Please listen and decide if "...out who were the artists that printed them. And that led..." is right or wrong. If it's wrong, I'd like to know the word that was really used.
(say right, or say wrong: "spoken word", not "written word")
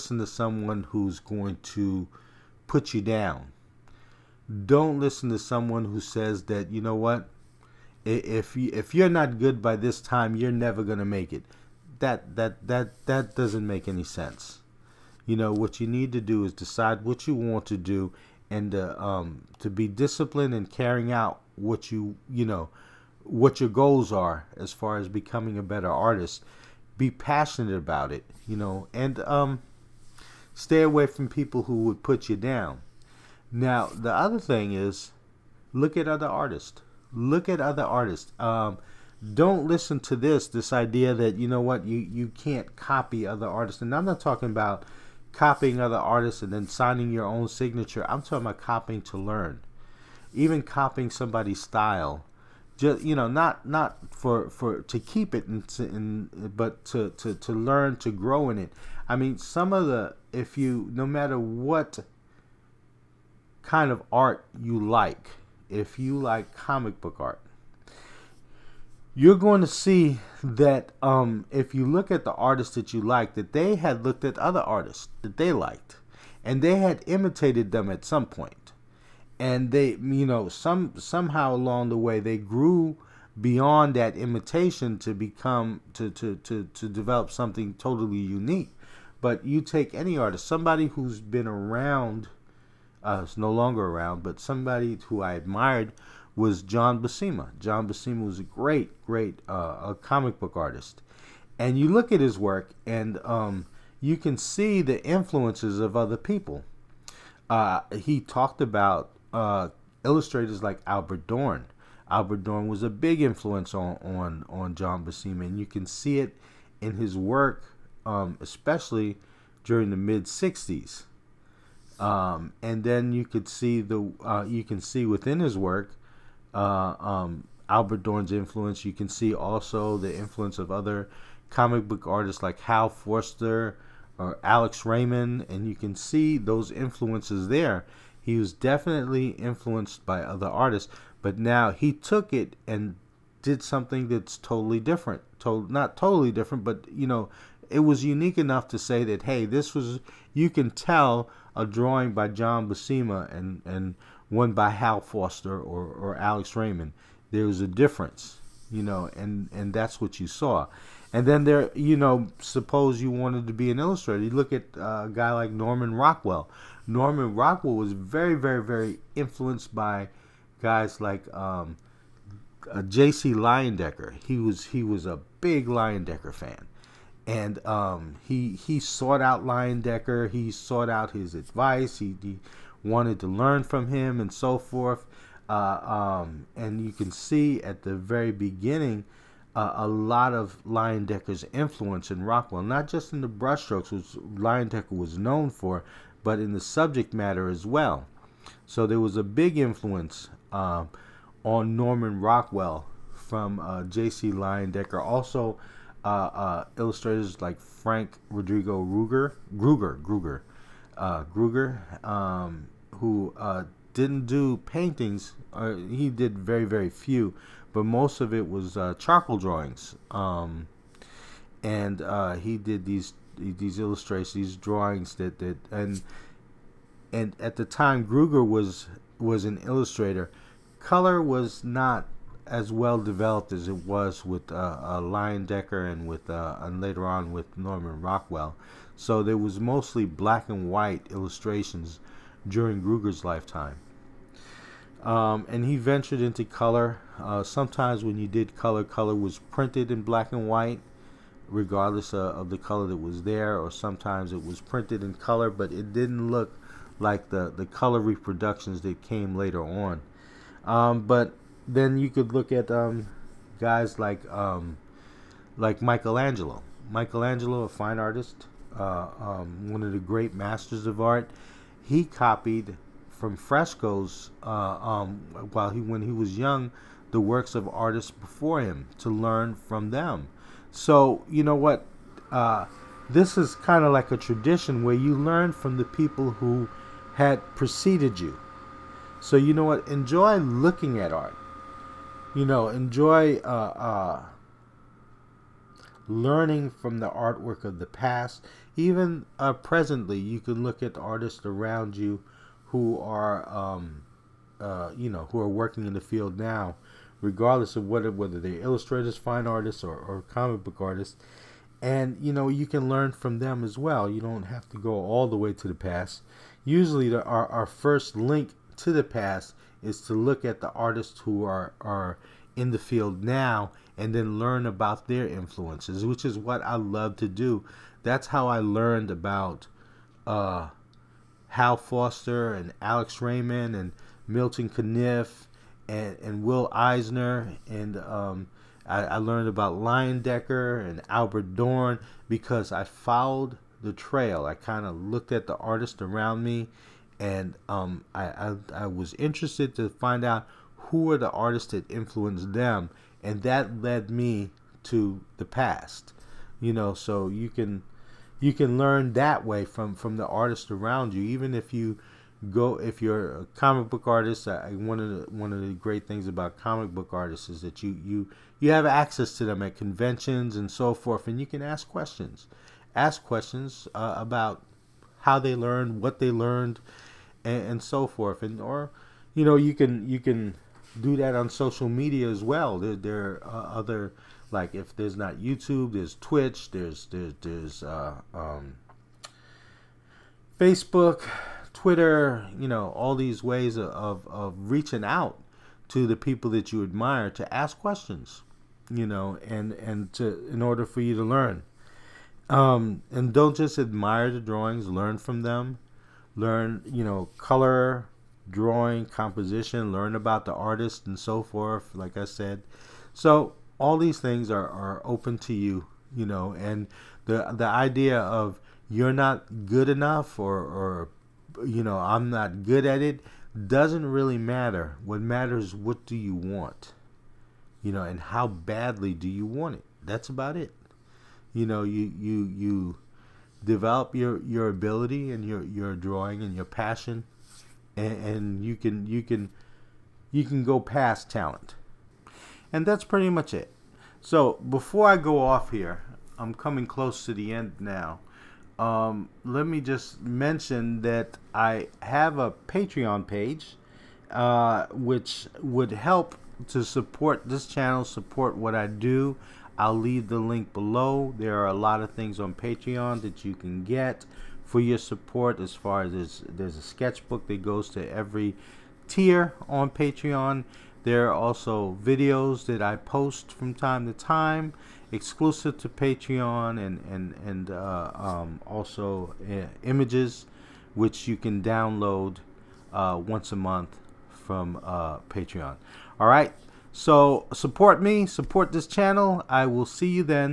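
wrong: "influenced", not "printed".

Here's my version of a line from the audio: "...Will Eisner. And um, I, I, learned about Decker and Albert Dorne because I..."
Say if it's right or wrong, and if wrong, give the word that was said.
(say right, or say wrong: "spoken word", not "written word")
right.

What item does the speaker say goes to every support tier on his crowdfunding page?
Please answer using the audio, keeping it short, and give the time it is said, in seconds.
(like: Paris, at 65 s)
a sketchbook, at 466 s.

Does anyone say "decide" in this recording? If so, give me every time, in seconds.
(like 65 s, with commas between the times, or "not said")
16 s.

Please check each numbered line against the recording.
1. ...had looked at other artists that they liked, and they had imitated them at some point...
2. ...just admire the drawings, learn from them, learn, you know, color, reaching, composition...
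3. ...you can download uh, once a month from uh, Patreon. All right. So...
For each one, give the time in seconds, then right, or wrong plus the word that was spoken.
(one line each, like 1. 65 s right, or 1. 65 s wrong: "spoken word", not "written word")
1. 73 s right
2. 403 s wrong: "drawing", not "reaching"
3. 481 s right.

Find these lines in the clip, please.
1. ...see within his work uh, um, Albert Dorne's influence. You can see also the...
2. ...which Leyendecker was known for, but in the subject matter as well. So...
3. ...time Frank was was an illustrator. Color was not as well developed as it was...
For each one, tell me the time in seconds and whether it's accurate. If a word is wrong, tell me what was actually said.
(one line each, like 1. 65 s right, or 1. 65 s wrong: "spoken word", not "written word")
1. 124 s right
2. 193 s right
3. 227 s wrong: "Gruger", not "Frank".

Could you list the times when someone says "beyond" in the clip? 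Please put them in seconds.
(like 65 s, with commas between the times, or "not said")
83 s.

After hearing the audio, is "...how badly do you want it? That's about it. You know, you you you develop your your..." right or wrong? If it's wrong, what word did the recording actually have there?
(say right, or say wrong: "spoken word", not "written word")
right.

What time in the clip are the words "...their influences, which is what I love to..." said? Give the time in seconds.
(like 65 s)
325 s.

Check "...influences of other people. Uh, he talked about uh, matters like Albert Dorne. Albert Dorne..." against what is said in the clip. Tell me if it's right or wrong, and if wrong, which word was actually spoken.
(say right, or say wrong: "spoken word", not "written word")
wrong: "illustrators", not "matters".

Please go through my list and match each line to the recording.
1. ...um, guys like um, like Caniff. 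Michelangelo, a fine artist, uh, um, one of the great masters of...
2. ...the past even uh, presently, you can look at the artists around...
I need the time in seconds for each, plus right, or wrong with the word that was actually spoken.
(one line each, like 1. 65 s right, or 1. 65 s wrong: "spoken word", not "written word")
1. 262 s wrong: "Michelangelo", not "Caniff"
2. 297 s right.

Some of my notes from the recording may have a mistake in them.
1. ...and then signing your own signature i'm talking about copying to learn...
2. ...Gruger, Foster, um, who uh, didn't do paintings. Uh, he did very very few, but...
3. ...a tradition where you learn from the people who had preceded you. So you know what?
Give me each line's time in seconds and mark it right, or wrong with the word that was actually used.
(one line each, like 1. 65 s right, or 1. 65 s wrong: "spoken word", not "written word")
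1. 46 s right
2. 210 s wrong: "Gruger", not "Foster"
3. 284 s right.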